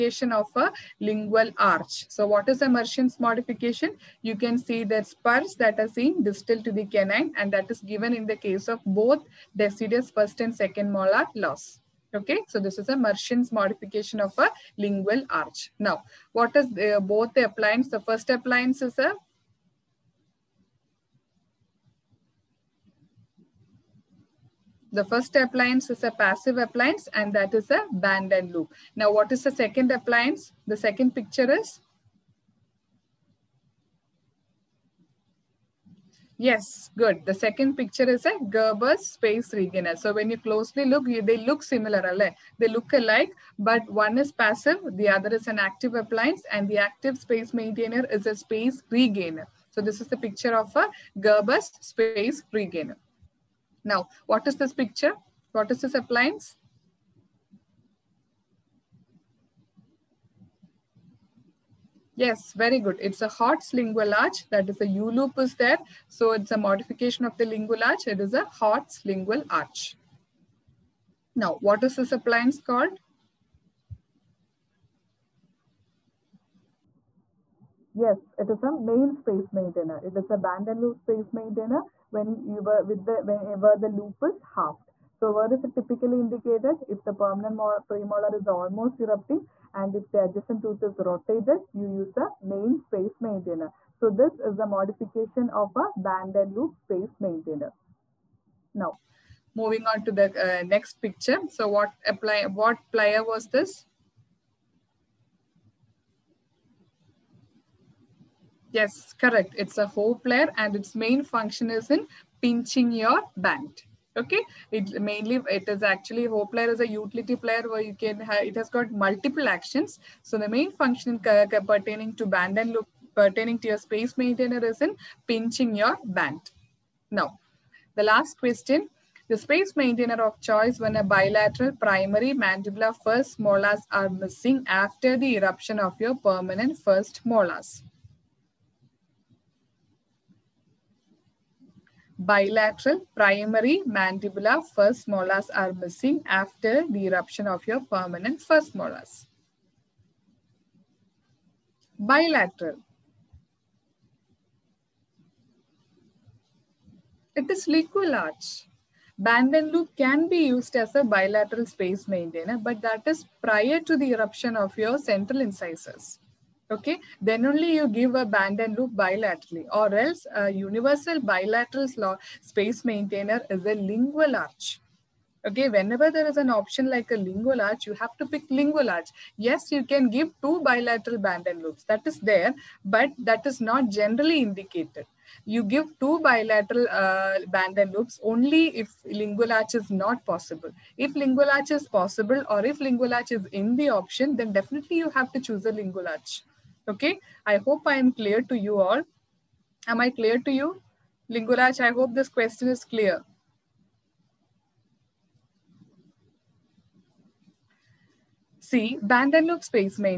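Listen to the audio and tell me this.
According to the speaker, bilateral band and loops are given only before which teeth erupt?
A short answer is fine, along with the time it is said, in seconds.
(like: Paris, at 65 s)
Central incisors, at 164 s.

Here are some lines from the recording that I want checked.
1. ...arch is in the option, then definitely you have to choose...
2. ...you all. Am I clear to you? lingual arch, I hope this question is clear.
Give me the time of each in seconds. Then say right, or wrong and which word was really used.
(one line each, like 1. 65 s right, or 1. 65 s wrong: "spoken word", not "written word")
1. 193 s right
2. 198 s right.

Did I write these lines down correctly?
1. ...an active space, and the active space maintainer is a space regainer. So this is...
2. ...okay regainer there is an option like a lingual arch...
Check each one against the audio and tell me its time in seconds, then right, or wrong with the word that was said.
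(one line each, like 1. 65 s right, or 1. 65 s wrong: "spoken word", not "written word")
1. 45 s wrong: "appliance", not "space"
2. 175 s wrong: "whenever", not "regainer".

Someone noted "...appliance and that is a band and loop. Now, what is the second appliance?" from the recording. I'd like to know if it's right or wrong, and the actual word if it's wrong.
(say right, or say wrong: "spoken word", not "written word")
right.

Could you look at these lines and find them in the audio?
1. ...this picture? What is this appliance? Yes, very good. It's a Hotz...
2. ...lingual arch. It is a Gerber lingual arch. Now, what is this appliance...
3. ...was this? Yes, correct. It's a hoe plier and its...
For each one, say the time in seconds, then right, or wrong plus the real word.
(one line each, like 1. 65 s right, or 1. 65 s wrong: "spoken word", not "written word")
1. 54 s right
2. 67 s wrong: "Hotz", not "Gerber"
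3. 103 s right.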